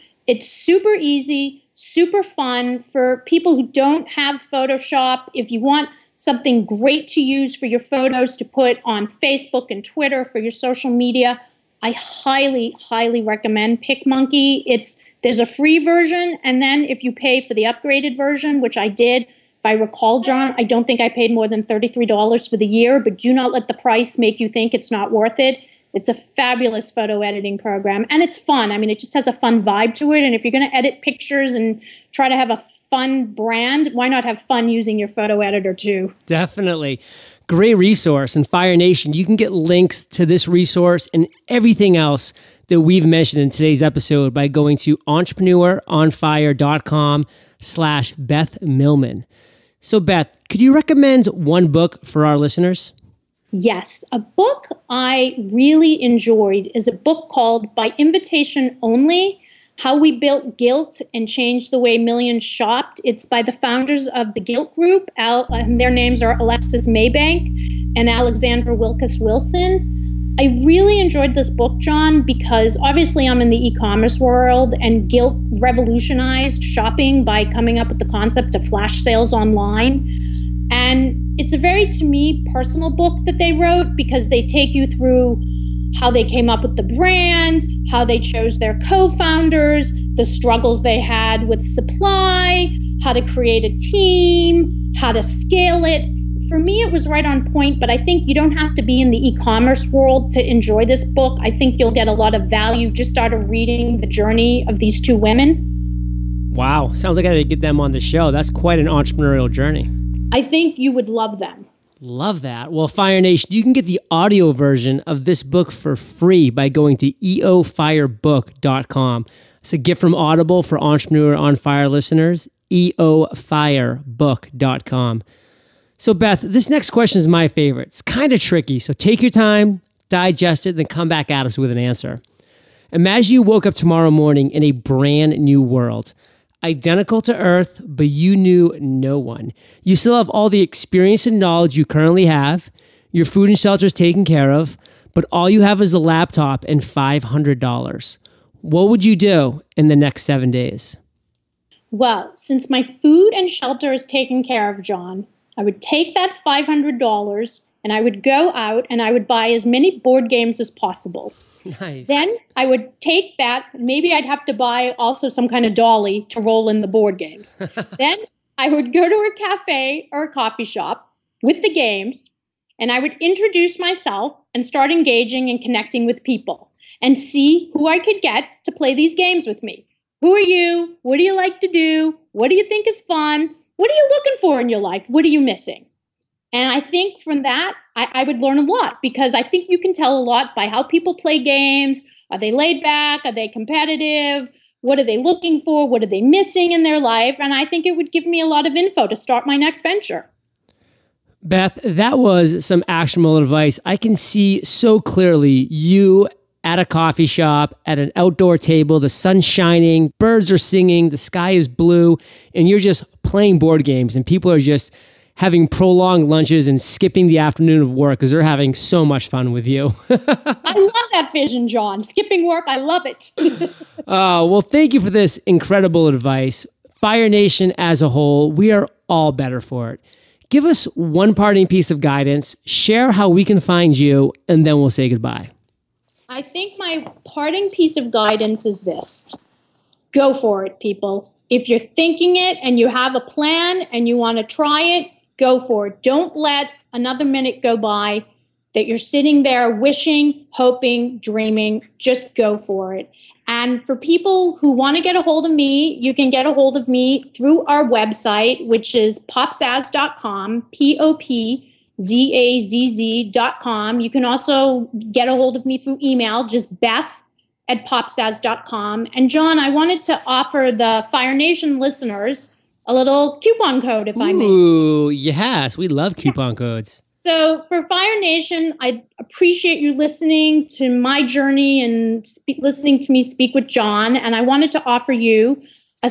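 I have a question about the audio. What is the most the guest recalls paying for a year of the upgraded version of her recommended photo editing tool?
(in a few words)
$33.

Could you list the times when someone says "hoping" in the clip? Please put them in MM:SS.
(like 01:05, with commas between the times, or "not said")
04:10.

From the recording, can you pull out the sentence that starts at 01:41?
I think you'll get a lot of value just out of reading the journey of these two women.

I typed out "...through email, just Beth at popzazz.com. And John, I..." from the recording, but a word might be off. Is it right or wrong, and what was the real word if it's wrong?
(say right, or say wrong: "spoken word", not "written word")
right.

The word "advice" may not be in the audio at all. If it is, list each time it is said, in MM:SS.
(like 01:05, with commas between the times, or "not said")
03:23, 03:46.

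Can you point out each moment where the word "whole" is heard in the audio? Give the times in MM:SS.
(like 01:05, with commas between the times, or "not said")
03:48.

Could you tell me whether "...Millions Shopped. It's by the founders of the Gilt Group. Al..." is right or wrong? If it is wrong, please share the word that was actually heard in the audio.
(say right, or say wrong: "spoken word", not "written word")
right.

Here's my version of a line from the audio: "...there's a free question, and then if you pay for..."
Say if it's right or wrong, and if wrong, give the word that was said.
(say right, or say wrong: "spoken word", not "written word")
wrong: "version", not "question".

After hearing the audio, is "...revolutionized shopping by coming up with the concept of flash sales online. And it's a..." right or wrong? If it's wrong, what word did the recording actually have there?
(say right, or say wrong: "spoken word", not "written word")
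right.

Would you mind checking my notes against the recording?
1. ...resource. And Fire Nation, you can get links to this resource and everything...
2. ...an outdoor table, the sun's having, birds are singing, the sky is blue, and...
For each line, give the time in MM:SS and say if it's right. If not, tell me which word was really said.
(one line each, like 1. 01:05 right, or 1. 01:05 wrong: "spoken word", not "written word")
1. 00:37 right
2. 03:27 wrong: "shining", not "having".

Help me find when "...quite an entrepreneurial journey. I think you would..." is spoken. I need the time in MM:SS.
01:48.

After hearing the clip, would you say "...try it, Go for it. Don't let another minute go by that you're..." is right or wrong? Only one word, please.
right.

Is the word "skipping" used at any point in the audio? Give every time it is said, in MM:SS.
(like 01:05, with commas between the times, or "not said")
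03:36, 03:42.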